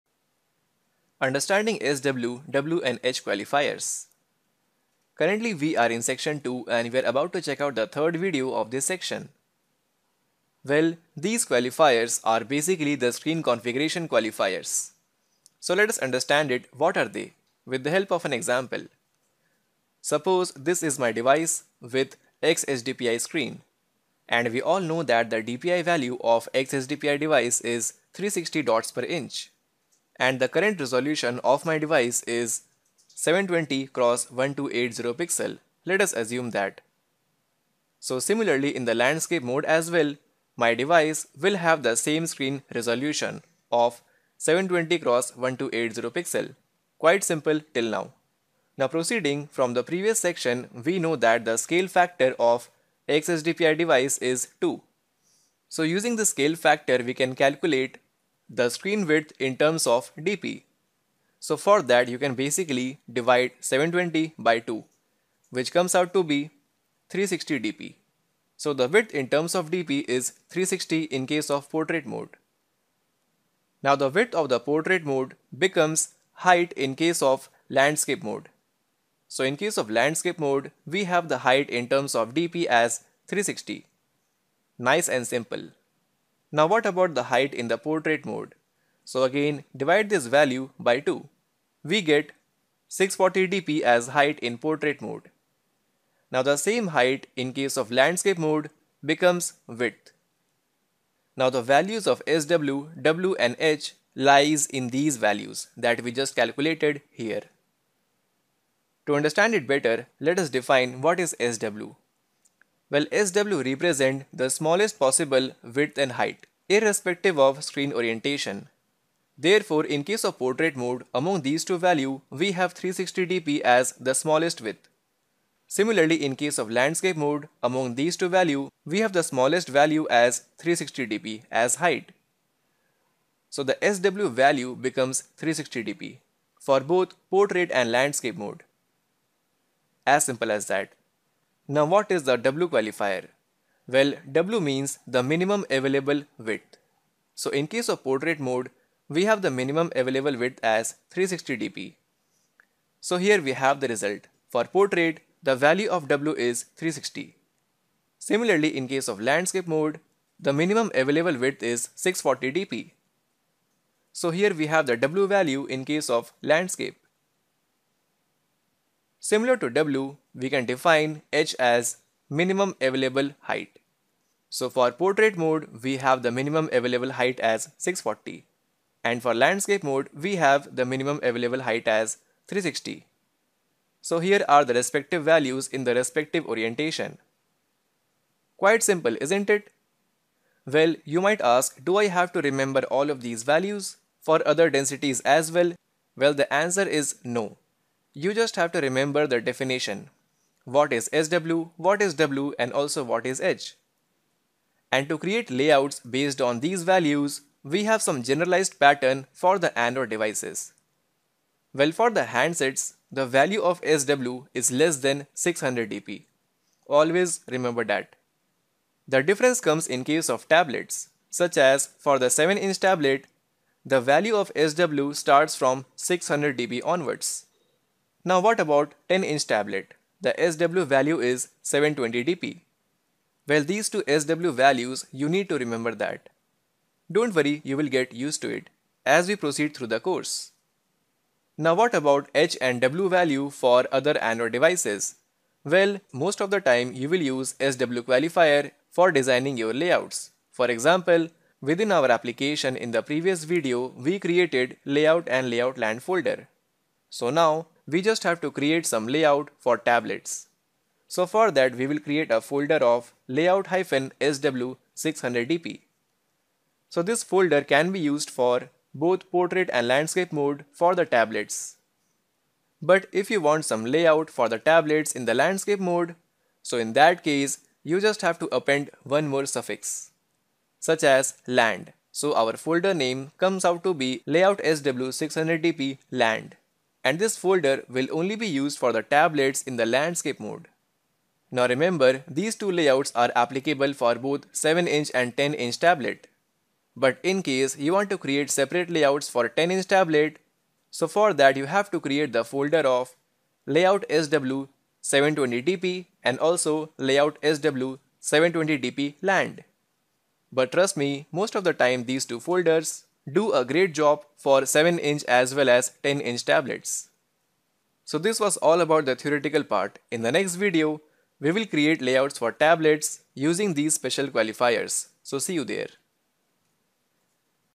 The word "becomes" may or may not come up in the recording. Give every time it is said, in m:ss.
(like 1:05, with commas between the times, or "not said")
1:15, 1:39, 2:14.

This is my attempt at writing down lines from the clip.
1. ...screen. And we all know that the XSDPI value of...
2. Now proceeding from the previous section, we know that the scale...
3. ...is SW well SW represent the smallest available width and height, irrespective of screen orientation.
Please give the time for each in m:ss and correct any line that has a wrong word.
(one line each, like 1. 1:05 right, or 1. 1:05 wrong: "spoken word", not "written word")
1. 0:23 wrong: "DPI", not "XSDPI"
2. 0:48 right
3. 1:51 wrong: "possible", not "available".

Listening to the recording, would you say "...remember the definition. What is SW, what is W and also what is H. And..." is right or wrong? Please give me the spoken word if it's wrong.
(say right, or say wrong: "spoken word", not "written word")
right.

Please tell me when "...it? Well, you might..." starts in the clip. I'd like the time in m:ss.
3:09.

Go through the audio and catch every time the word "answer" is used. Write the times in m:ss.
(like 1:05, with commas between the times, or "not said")
3:16.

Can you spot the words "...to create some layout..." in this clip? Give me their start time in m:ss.
4:18.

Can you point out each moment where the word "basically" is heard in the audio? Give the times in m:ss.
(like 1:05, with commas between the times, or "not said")
0:12, 1:02.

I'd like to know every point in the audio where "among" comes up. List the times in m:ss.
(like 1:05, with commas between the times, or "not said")
2:01, 2:07.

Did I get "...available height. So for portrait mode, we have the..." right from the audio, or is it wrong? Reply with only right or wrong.
right.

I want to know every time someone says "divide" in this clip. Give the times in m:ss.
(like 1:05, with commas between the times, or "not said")
1:03, 1:29.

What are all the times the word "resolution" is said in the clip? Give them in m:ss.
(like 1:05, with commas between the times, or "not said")
0:30, 0:42.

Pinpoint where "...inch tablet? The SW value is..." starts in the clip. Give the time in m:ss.
3:49.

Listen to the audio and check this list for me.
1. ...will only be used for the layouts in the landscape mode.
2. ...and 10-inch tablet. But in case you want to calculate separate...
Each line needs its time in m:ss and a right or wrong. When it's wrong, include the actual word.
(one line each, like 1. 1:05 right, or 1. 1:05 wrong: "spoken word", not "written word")
1. 4:47 wrong: "tablets", not "layouts"
2. 4:55 wrong: "create", not "calculate".